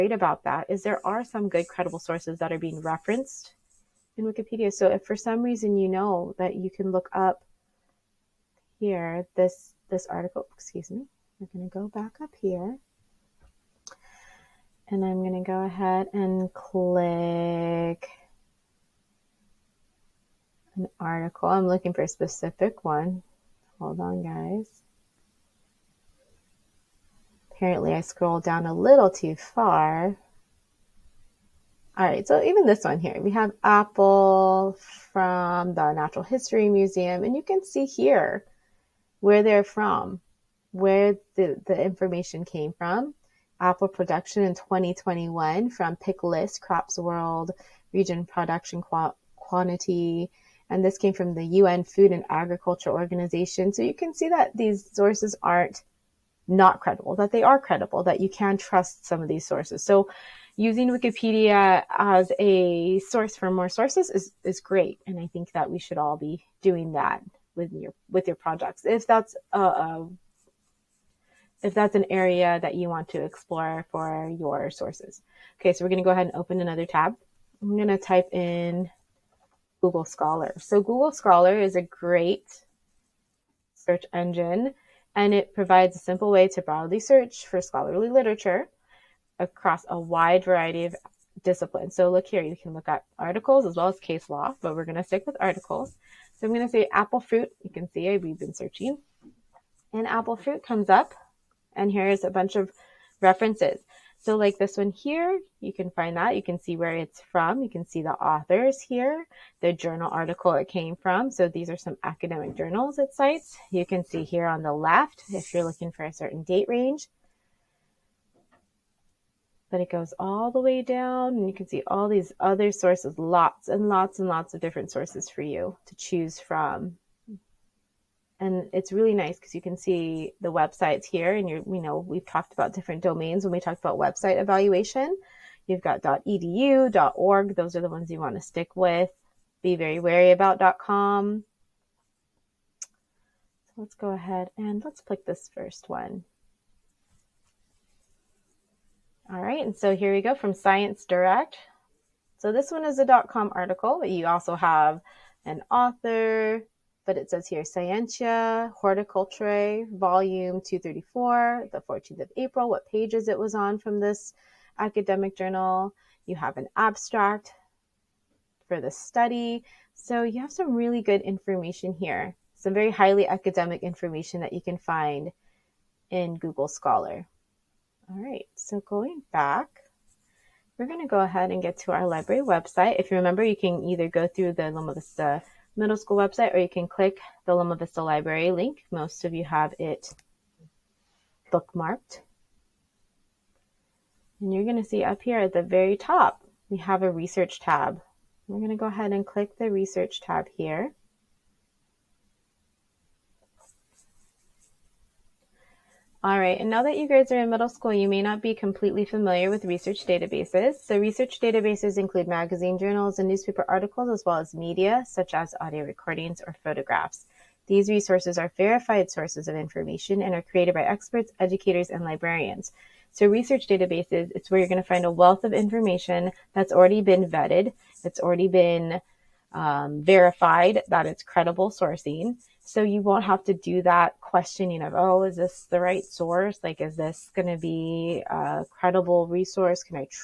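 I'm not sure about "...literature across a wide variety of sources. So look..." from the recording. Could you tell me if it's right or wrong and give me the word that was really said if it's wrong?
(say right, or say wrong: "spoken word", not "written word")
wrong: "disciplines", not "sources".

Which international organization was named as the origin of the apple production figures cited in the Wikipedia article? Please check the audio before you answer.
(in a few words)
UN Food and Agriculture Organization.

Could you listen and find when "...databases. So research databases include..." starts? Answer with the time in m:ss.
3:30.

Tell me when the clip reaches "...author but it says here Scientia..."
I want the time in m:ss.
2:35.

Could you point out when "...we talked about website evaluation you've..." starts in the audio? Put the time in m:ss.
2:13.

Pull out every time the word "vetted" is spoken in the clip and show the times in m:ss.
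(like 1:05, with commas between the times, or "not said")
3:47.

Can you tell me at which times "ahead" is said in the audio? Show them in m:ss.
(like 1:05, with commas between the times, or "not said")
0:15, 1:16, 2:24, 3:01, 3:18.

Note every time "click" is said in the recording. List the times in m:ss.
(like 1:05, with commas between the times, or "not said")
0:16, 2:24, 3:06, 3:19.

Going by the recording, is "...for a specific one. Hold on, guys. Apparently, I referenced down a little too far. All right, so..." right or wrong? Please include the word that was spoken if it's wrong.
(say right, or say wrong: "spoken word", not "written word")
wrong: "scrolled", not "referenced".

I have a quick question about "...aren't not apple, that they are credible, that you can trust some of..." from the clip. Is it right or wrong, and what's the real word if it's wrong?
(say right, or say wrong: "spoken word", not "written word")
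wrong: "credible", not "apple".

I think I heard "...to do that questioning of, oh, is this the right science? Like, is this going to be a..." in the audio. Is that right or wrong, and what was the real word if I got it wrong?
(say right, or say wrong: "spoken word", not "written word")
wrong: "source", not "science".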